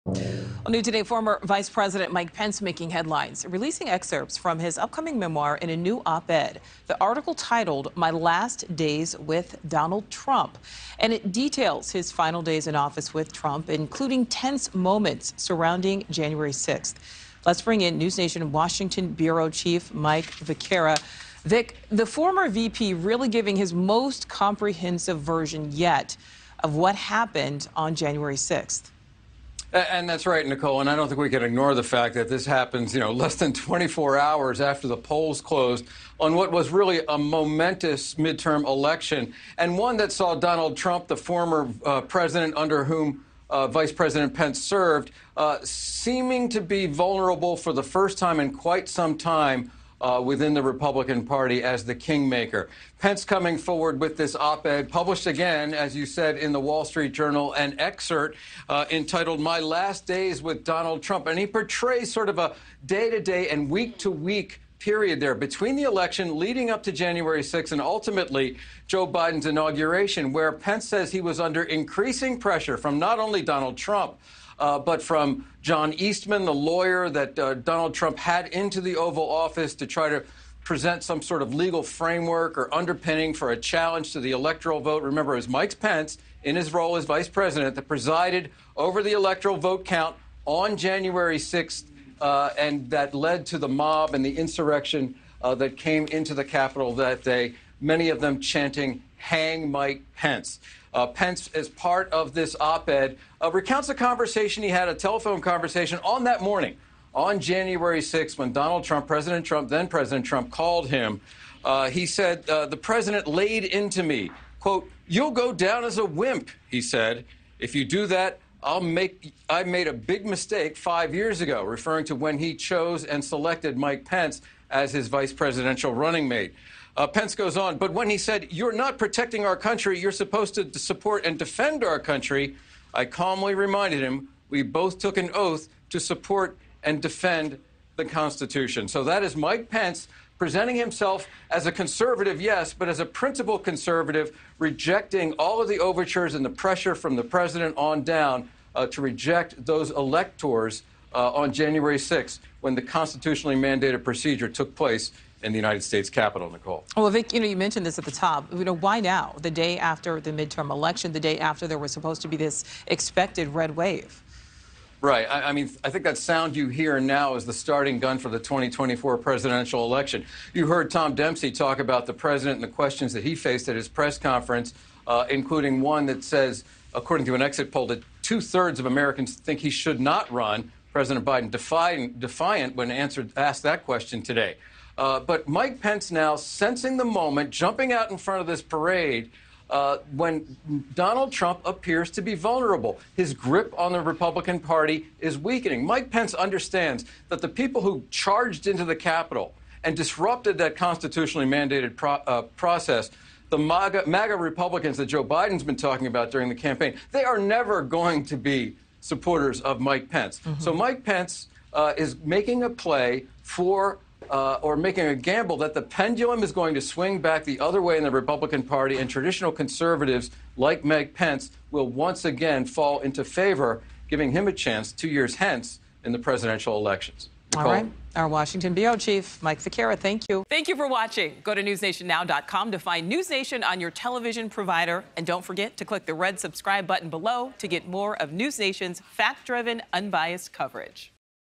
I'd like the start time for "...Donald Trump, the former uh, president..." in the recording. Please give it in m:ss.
0:40.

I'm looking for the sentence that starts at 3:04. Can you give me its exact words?
Uh, but Mike Pence now sensing the moment, jumping out in front of this parade.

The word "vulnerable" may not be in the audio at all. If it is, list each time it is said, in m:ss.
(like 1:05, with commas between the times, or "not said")
0:46, 3:12.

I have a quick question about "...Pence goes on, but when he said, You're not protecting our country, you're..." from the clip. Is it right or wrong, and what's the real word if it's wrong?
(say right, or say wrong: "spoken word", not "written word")
right.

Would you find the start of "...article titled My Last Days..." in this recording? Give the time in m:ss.
0:07.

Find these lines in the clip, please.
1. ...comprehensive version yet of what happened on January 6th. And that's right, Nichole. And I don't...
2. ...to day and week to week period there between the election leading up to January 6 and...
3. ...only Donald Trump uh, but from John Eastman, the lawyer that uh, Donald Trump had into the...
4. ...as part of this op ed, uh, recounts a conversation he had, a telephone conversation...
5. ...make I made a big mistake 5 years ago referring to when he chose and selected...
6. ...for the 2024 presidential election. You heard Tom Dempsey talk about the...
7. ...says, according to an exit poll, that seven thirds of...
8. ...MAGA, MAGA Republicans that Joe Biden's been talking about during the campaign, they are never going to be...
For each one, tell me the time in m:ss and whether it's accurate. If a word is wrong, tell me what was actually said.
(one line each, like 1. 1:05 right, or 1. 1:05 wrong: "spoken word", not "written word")
1. 0:24 right
2. 1:03 right
3. 1:13 right
4. 1:41 right
5. 1:58 right
6. 2:48 right
7. 2:56 wrong: "two", not "seven"
8. 3:23 right.